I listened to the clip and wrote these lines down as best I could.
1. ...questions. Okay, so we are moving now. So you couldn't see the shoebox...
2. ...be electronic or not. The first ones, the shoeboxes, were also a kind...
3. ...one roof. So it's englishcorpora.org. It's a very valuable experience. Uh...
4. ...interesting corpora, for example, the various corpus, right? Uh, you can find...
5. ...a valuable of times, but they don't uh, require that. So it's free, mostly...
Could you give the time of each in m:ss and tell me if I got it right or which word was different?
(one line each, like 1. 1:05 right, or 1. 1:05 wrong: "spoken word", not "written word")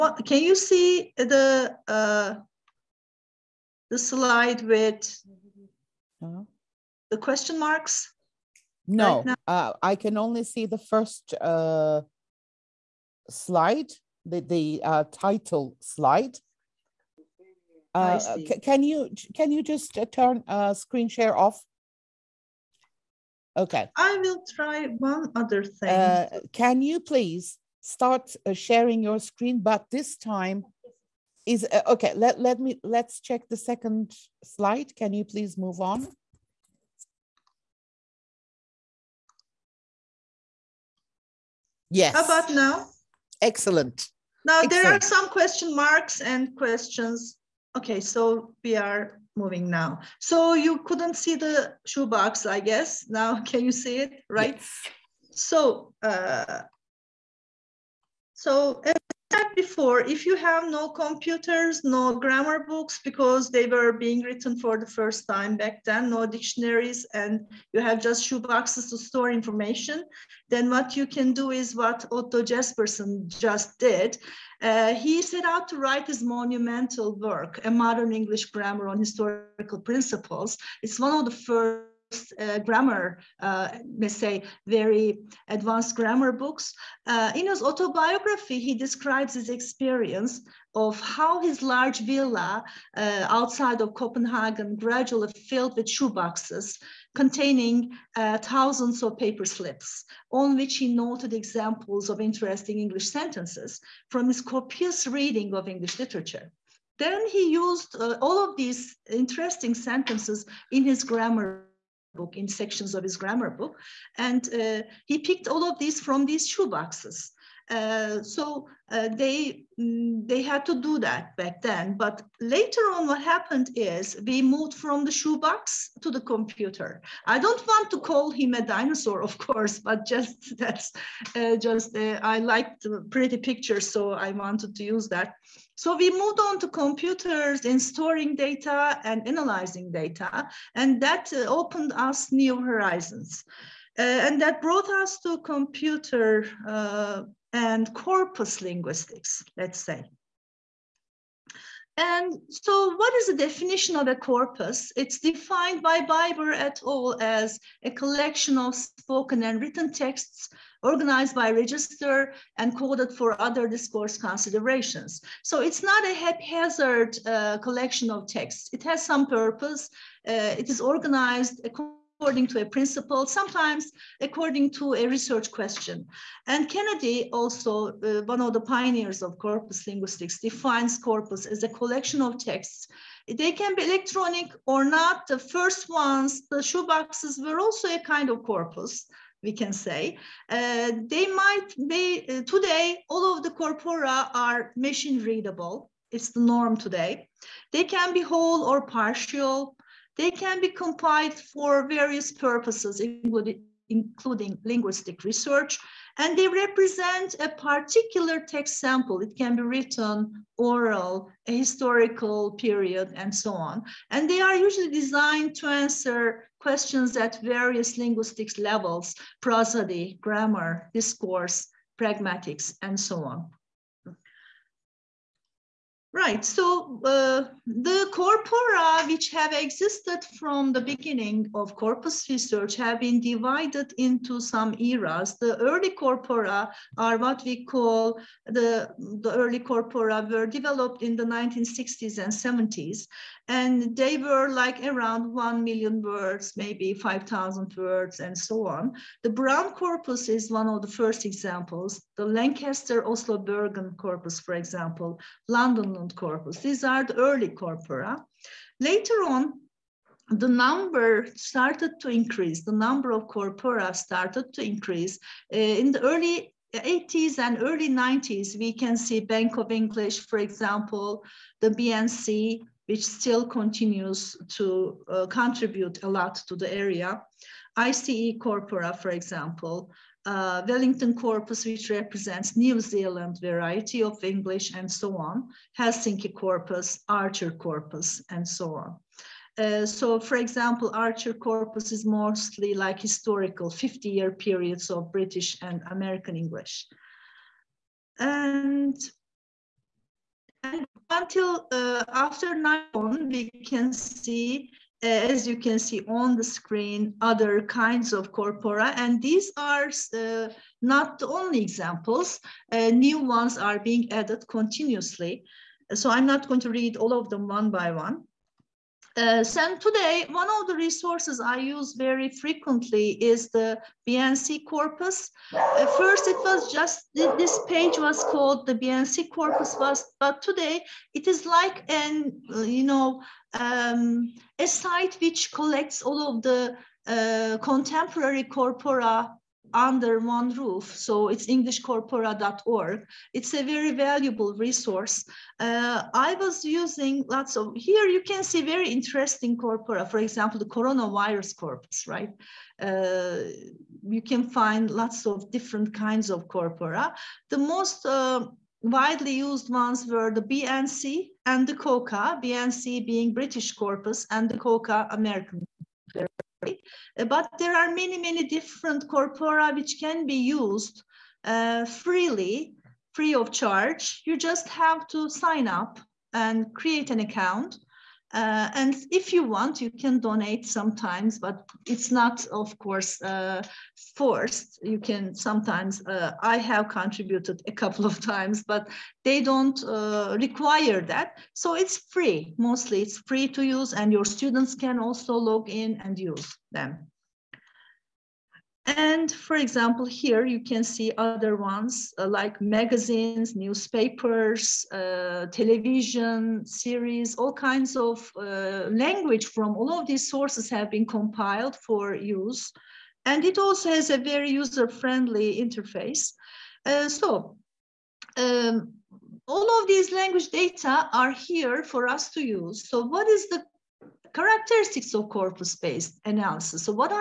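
1. 0:46 right
2. 3:03 right
3. 5:40 wrong: "resource", not "experience"
4. 5:48 wrong: "coronavirus", not "various"
5. 6:27 wrong: "couple", not "valuable".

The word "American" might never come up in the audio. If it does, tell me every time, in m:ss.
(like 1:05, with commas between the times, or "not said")
4:55, 6:05.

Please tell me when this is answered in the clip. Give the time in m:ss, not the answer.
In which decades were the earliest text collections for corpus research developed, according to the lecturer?
4:01.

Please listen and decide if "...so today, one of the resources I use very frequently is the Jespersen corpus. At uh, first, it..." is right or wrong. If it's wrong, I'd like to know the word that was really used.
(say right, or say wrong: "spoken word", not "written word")
wrong: "BNC", not "Jespersen".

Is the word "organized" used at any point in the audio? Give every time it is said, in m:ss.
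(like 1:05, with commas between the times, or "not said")
2:40, 2:50.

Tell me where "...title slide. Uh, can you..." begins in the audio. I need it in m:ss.
0:15.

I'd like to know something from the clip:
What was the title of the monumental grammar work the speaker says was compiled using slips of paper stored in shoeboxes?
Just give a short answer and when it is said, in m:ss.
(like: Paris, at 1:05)
A Modern English Grammar on Historical Principles, at 1:17.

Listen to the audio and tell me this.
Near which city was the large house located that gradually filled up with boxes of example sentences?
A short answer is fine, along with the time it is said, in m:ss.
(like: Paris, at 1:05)
Copenhagen, at 1:33.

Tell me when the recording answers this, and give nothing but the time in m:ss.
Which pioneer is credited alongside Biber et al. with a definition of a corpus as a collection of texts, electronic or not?
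2:56.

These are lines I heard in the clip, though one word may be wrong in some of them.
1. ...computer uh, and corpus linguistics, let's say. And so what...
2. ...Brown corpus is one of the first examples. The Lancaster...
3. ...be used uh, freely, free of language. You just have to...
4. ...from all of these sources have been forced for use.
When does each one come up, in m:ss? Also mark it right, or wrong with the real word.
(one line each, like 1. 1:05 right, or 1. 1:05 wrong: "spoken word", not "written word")
1. 2:25 right
2. 4:09 right
3. 6:10 wrong: "charge", not "language"
4. 6:49 wrong: "compiled", not "forced".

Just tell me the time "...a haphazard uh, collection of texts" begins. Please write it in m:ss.
2:46.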